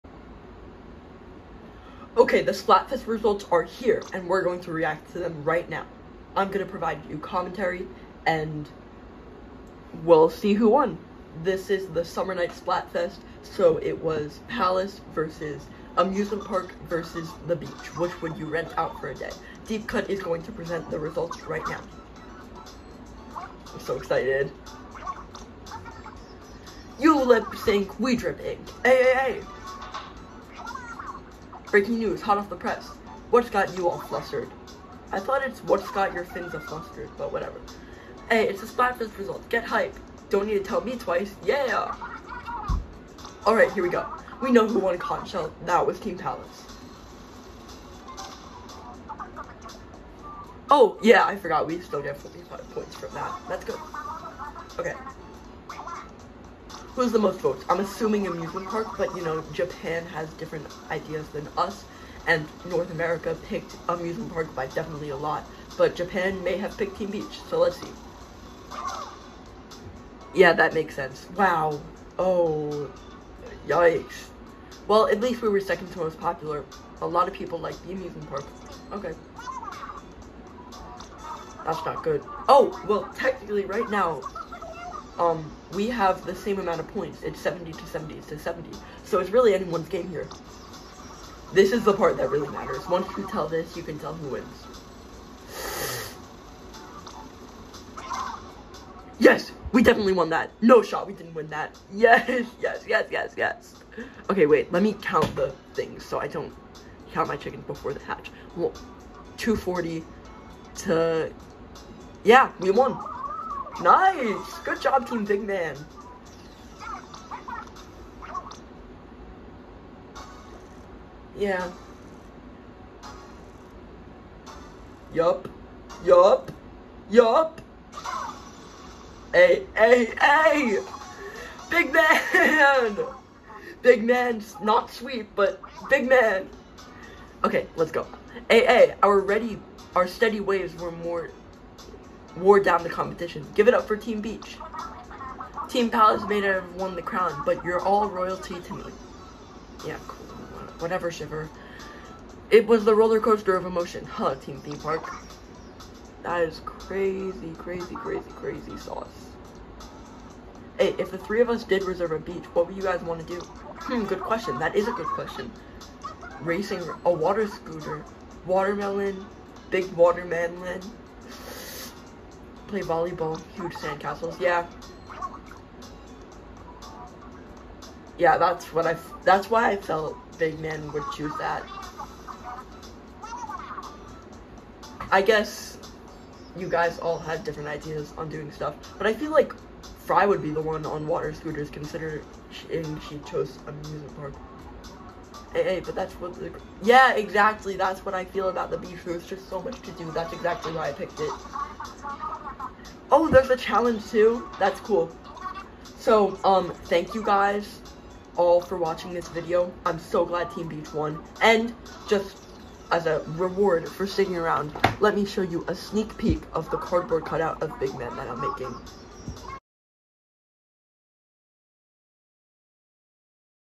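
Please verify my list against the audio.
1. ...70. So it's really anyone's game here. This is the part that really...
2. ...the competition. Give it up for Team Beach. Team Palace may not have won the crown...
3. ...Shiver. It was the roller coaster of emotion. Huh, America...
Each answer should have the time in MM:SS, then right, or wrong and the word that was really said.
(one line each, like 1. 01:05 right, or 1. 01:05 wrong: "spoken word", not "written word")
1. 01:28 right
2. 02:22 right
3. 02:31 wrong: "Team", not "America".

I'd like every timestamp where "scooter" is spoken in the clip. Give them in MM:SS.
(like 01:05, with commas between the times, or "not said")
02:47, 03:11.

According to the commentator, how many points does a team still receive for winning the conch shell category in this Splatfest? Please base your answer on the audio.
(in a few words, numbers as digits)
45.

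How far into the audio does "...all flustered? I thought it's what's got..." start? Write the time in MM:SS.
00:33.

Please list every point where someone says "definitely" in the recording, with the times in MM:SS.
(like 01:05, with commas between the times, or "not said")
01:04, 01:39.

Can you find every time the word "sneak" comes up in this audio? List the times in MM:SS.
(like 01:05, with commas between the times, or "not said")
03:35.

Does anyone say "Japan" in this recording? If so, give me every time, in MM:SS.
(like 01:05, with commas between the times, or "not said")
00:59, 01:05.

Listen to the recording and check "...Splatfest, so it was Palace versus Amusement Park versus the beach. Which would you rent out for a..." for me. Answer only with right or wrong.
right.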